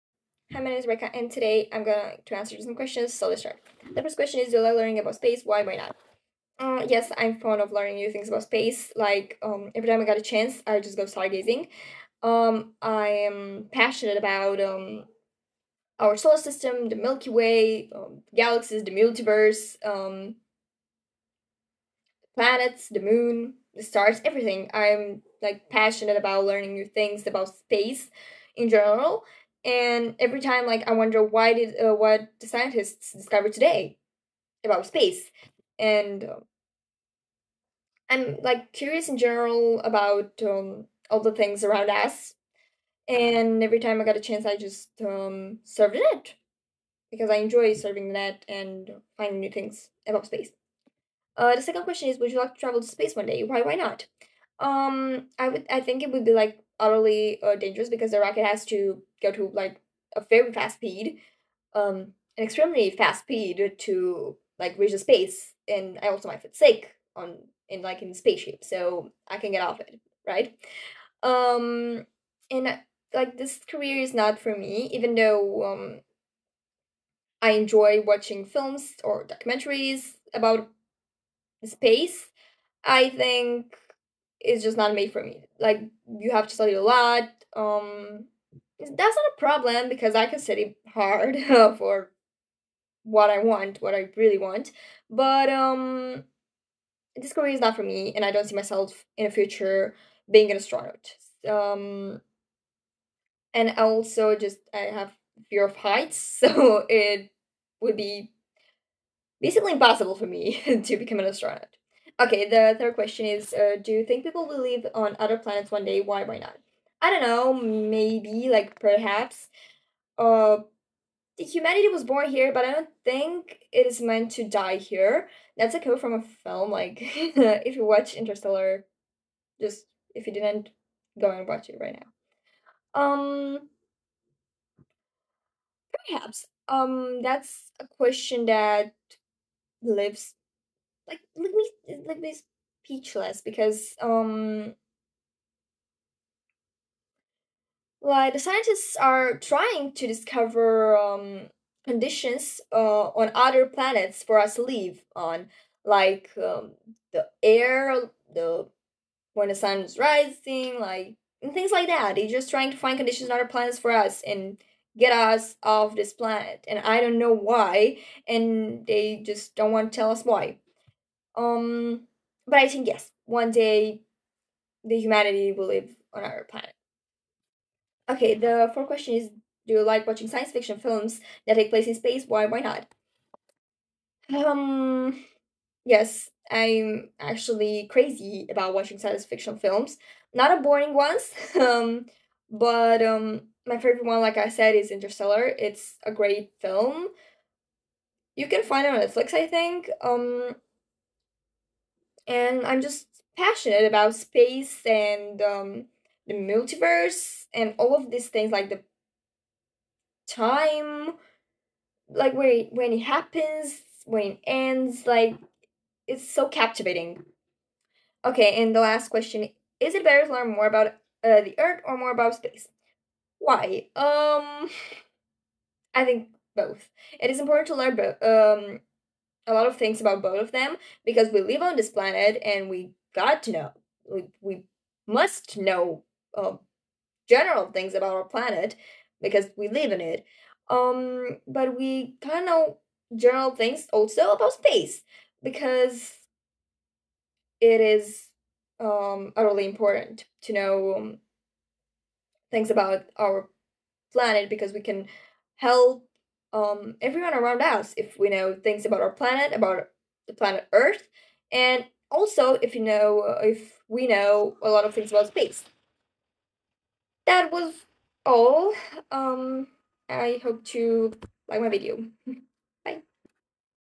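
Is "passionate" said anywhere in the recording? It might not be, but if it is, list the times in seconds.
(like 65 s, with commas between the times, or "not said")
13 s, 25 s, 203 s.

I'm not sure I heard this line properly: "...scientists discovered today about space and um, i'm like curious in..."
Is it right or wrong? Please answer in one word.
right.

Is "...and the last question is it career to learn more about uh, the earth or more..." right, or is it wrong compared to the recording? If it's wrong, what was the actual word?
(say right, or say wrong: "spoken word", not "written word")
wrong: "better", not "career".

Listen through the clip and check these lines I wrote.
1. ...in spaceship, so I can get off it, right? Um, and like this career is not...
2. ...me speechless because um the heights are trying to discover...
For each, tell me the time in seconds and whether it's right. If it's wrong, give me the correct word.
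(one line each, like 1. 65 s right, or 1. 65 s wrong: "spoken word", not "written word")
1. 68 s right
2. 142 s wrong: "scientists", not "heights".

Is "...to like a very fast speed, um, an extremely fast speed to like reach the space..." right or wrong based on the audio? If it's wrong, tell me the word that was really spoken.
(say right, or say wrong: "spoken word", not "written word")
right.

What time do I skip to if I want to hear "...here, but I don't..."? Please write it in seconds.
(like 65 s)
122 s.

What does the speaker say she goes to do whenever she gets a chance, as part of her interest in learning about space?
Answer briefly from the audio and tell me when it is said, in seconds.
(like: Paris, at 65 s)
Stargazing, at 11 s.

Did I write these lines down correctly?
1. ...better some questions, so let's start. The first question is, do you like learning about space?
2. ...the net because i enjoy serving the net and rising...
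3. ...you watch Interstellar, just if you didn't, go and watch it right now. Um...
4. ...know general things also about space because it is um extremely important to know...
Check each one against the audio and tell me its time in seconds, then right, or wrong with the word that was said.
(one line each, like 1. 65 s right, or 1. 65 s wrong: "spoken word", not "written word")
1. 2 s wrong: "answer", not "better"
2. 45 s wrong: "finding", not "rising"
3. 127 s right
4. 242 s wrong: "utterly", not "extremely".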